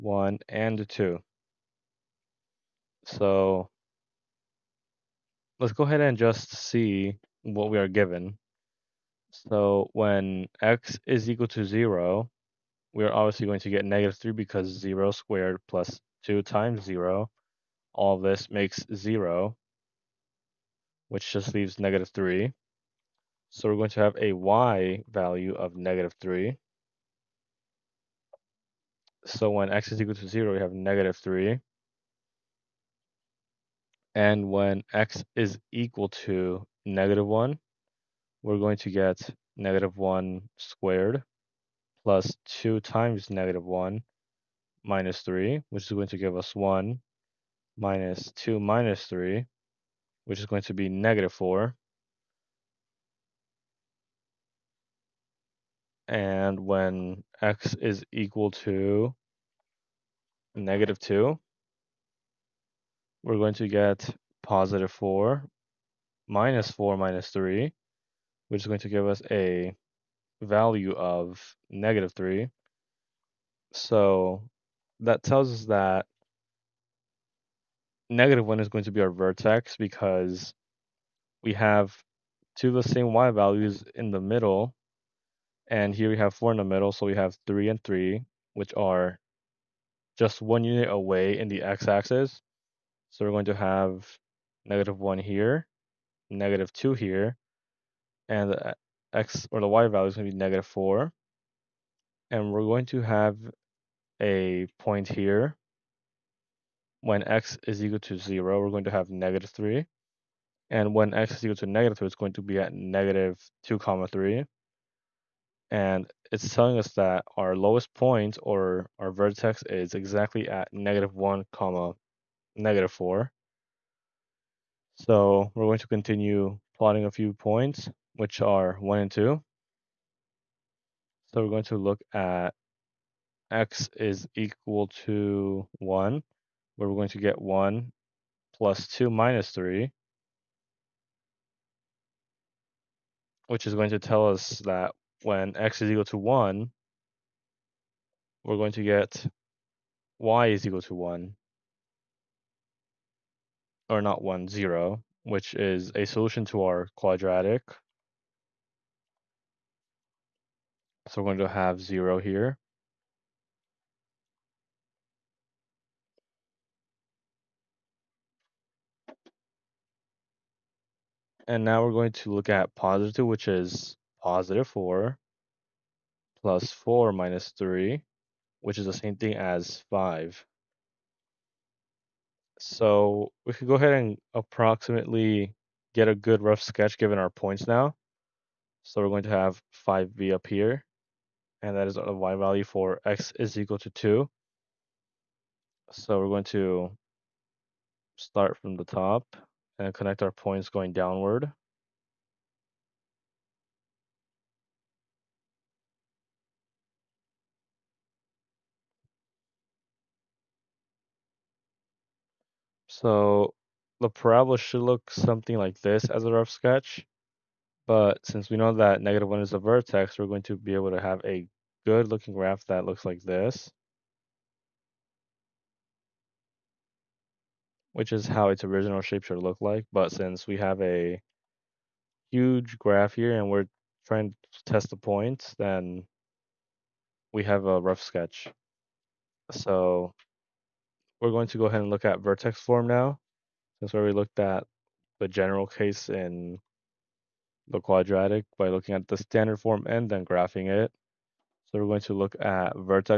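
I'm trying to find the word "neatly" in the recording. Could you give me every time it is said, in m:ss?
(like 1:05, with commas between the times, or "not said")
not said.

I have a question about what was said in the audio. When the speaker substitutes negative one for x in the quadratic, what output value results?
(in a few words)
-4.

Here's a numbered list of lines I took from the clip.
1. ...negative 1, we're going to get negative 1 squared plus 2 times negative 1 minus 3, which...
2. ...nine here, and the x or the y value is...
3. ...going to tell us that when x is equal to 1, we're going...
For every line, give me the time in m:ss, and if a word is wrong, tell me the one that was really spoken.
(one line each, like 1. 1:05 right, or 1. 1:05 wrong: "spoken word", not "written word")
1. 0:36 right
2. 1:36 wrong: "two", not "nine"
3. 2:23 right.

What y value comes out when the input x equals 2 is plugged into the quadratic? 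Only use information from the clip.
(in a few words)
5.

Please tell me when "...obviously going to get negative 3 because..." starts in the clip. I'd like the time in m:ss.
0:13.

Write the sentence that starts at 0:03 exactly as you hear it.
So let's go ahead and just see what we are given.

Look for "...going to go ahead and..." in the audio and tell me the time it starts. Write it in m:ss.
4:01.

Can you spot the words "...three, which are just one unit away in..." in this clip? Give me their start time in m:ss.
1:27.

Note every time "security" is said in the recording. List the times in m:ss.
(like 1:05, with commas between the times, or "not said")
not said.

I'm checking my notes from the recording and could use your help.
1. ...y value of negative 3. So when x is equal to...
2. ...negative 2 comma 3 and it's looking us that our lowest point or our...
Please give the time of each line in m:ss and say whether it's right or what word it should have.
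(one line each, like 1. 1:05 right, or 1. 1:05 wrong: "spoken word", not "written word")
1. 0:24 right
2. 1:52 wrong: "telling", not "looking".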